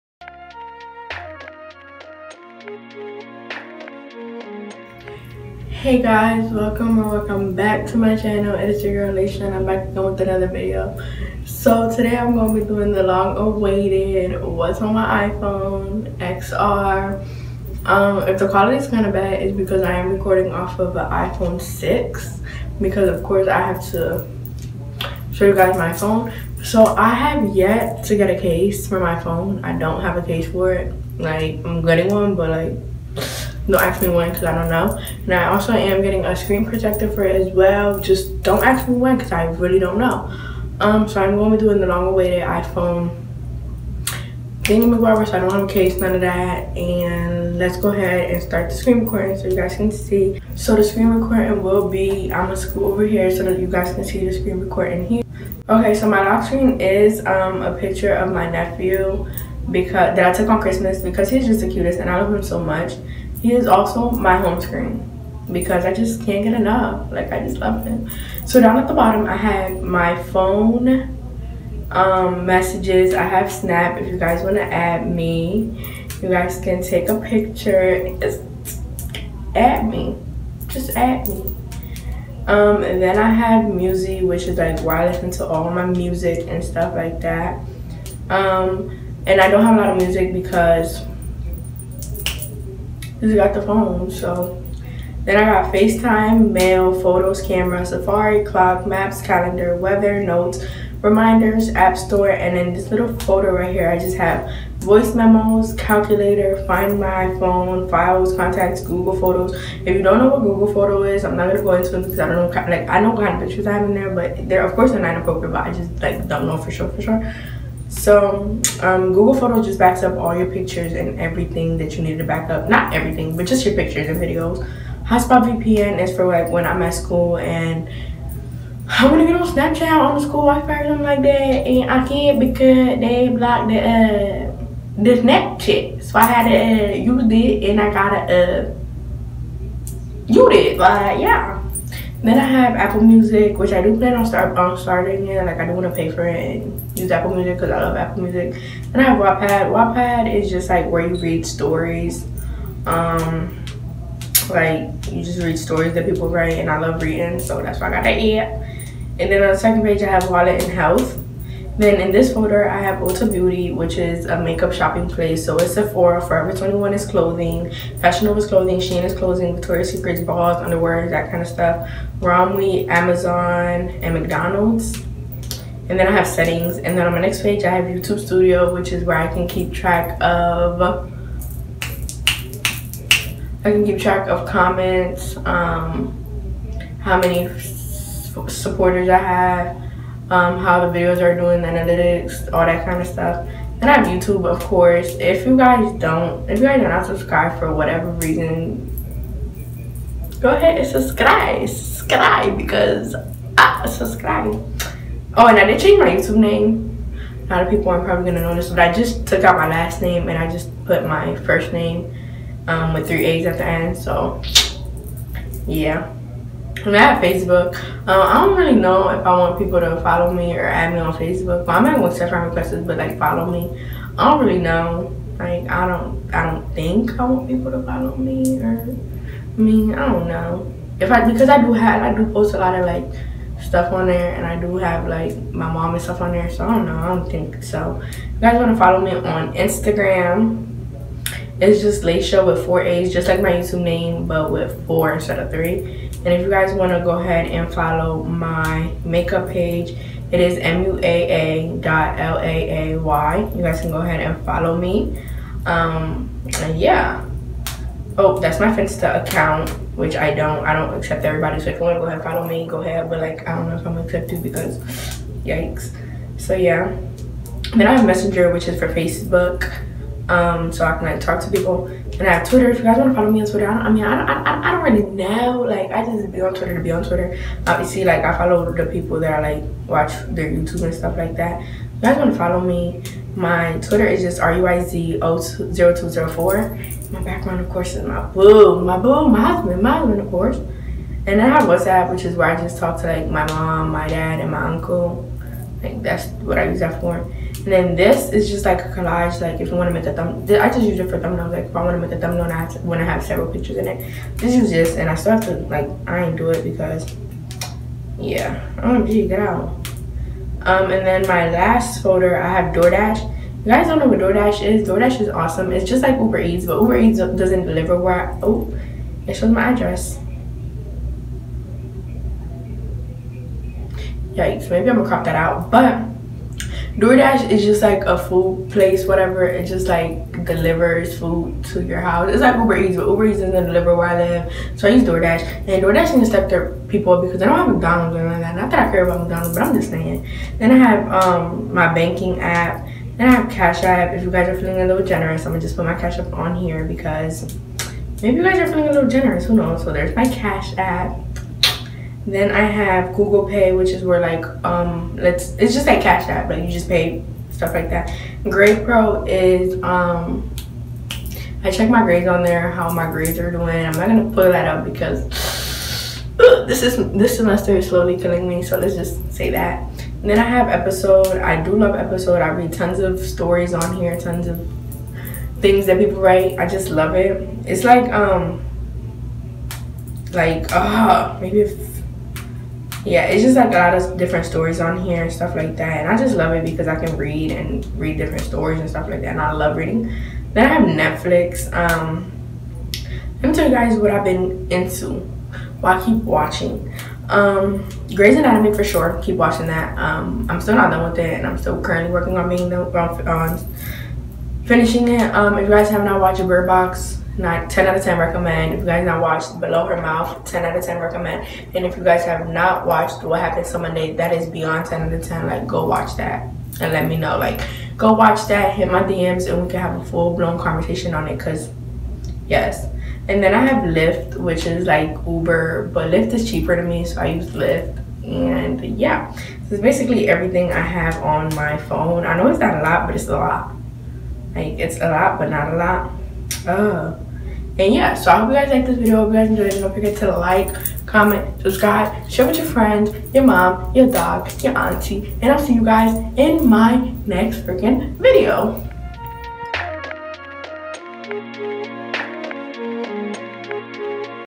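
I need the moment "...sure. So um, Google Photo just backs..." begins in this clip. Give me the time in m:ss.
1:57.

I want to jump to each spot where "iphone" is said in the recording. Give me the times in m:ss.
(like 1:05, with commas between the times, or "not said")
0:15, 0:21, 0:42.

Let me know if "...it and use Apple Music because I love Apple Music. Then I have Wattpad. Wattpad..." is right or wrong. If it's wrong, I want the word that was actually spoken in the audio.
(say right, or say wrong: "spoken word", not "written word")
right.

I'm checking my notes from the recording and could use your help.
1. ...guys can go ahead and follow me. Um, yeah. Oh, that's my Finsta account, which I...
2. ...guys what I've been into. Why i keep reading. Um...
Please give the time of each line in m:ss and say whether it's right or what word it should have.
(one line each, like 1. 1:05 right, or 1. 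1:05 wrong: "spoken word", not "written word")
1. 4:13 right
2. 6:33 wrong: "watching", not "reading".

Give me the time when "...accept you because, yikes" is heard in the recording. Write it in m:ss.
4:24.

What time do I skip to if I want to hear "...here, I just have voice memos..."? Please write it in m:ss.
1:43.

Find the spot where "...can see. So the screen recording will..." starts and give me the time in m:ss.
0:49.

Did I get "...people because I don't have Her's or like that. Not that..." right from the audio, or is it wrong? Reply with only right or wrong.
wrong.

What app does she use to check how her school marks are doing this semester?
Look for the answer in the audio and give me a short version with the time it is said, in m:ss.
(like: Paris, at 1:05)
Grade Pro, at 5:58.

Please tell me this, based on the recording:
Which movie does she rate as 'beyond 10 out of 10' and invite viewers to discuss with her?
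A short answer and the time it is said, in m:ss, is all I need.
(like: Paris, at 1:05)
What Happened to Monday, at 6:53.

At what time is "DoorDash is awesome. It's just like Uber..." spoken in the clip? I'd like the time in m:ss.
5:14.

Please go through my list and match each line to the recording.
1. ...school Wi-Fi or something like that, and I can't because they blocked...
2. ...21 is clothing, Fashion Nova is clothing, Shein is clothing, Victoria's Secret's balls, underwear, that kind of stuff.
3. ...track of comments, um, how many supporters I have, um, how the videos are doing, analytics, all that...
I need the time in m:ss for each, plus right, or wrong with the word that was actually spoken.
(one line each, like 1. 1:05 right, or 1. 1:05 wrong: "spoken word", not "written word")
1. 2:10 right
2. 2:46 right
3. 3:03 right.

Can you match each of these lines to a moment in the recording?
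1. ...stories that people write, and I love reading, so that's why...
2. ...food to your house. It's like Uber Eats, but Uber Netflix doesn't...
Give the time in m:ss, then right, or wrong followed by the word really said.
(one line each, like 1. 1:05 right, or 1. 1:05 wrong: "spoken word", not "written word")
1. 2:35 right
2. 5:31 wrong: "Eats", not "Netflix".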